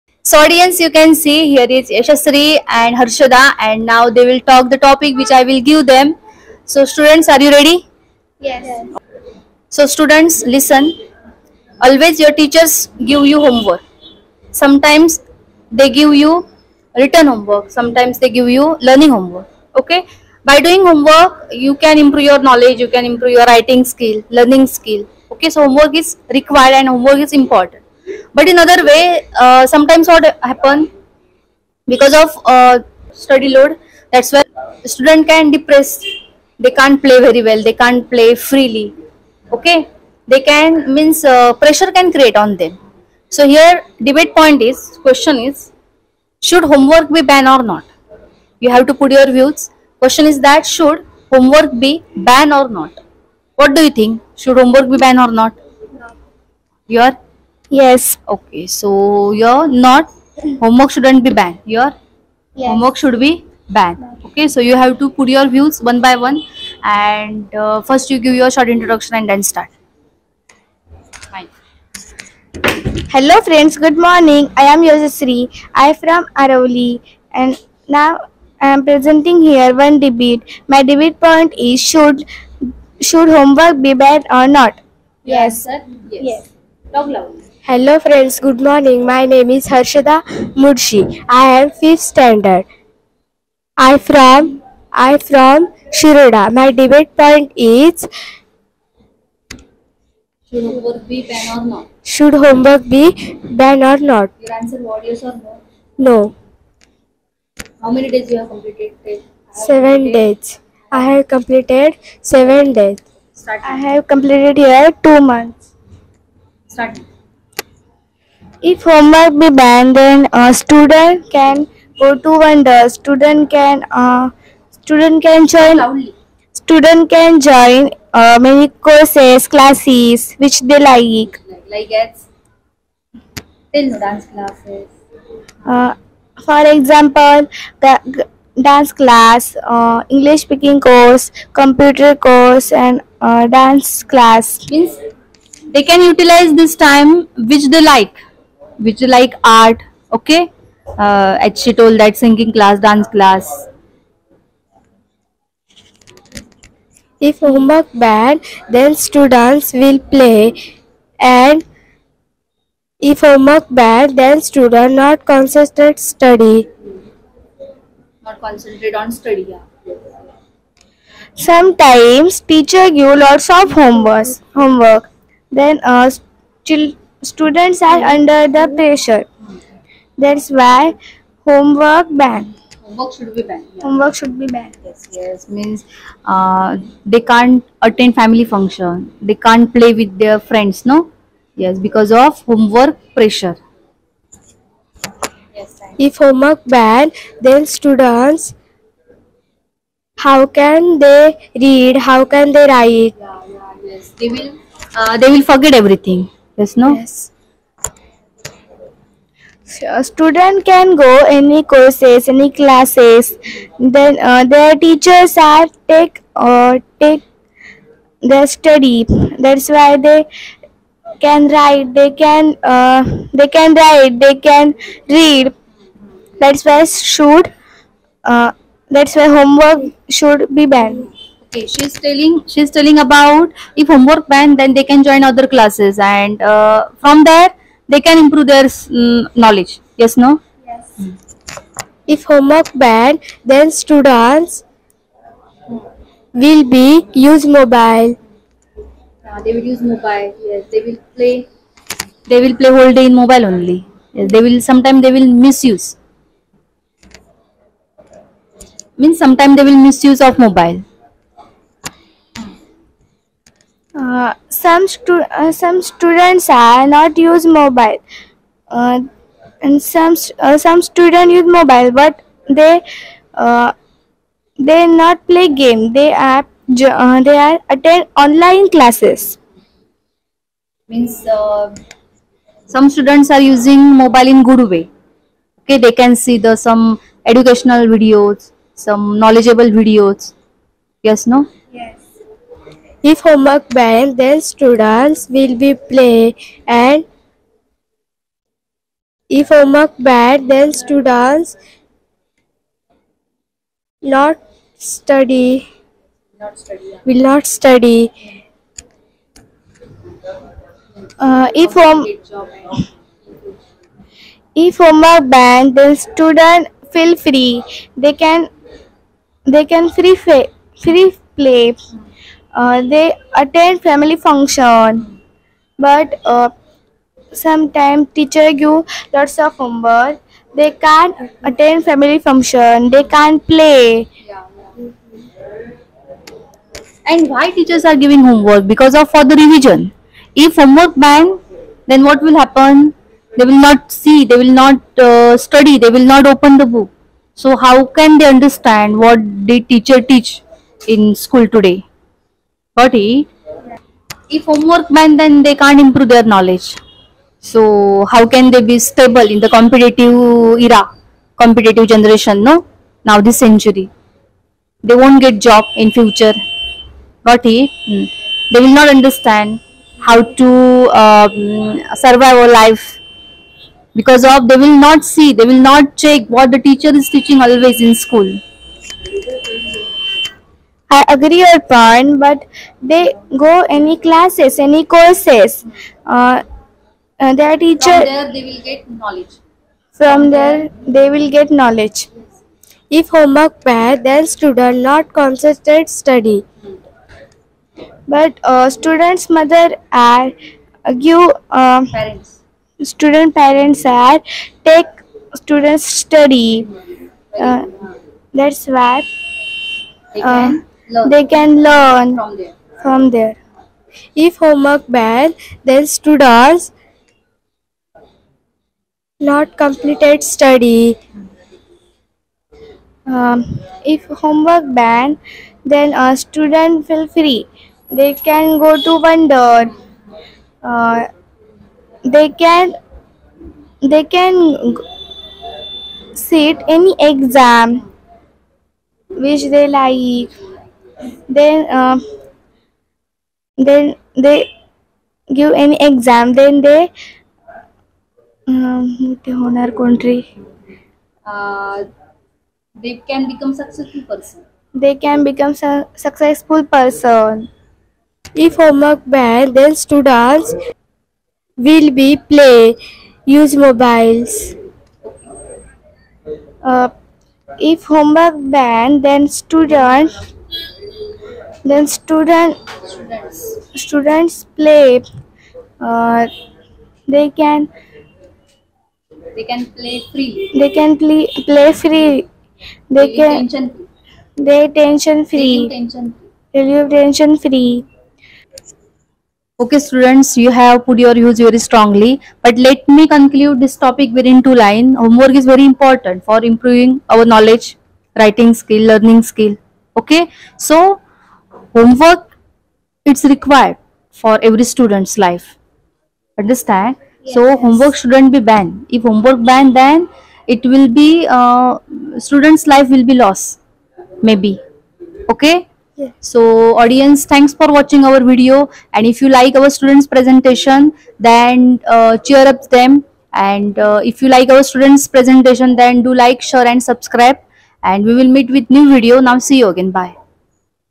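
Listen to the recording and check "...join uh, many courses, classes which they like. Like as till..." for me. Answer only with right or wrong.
right.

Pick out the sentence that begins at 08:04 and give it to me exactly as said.
they tension free relieve tension free, tension free.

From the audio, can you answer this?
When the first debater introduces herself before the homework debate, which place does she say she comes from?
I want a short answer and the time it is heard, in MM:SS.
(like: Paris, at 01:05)
Aravali, at 01:16.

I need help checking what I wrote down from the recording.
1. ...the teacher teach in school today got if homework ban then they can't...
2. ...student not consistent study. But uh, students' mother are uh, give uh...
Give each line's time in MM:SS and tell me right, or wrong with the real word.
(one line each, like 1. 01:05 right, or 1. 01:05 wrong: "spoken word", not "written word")
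1. 05:49 right
2. 06:34 right.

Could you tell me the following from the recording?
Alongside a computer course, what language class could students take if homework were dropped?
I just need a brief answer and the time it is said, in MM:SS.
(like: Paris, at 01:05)
English speaking course, at 02:20.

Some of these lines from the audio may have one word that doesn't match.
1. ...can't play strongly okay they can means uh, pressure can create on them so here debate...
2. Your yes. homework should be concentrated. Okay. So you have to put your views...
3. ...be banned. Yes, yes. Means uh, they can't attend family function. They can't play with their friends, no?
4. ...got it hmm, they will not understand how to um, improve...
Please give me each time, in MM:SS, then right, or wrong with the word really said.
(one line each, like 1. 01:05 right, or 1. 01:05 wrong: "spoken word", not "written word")
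1. 00:37 wrong: "freely", not "strongly"
2. 01:01 wrong: "banned", not "concentrated"
3. 03:04 right
4. 06:07 wrong: "survive", not "improve".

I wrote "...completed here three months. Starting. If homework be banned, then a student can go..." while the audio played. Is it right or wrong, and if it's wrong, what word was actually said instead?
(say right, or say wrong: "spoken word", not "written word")
wrong: "two", not "three".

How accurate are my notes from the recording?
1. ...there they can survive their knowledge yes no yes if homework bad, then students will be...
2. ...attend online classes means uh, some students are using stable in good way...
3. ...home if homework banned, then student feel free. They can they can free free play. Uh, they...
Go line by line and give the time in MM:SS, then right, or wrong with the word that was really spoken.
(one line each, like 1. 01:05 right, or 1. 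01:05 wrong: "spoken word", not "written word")
1. 03:57 wrong: "improve", not "survive"
2. 04:37 wrong: "mobile", not "stable"
3. 05:11 right.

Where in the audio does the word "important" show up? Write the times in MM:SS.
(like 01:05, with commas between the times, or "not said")
00:27, 08:15.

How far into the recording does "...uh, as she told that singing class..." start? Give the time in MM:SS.
02:30.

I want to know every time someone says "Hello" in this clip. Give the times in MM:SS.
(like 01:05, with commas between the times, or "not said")
01:13, 01:27.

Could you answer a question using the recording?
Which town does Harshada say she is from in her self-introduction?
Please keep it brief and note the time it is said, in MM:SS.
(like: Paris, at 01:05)
Shiroda, at 01:35.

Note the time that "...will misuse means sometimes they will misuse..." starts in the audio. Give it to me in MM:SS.
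04:15.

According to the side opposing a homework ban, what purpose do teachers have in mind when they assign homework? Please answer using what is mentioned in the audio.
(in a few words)
Revision.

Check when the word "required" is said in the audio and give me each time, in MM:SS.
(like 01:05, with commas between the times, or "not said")
00:26, 08:23.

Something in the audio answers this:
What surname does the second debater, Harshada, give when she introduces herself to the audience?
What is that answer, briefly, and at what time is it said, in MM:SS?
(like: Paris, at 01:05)
Mudshi, at 01:30.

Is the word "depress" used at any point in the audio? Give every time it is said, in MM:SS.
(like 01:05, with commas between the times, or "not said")
00:35.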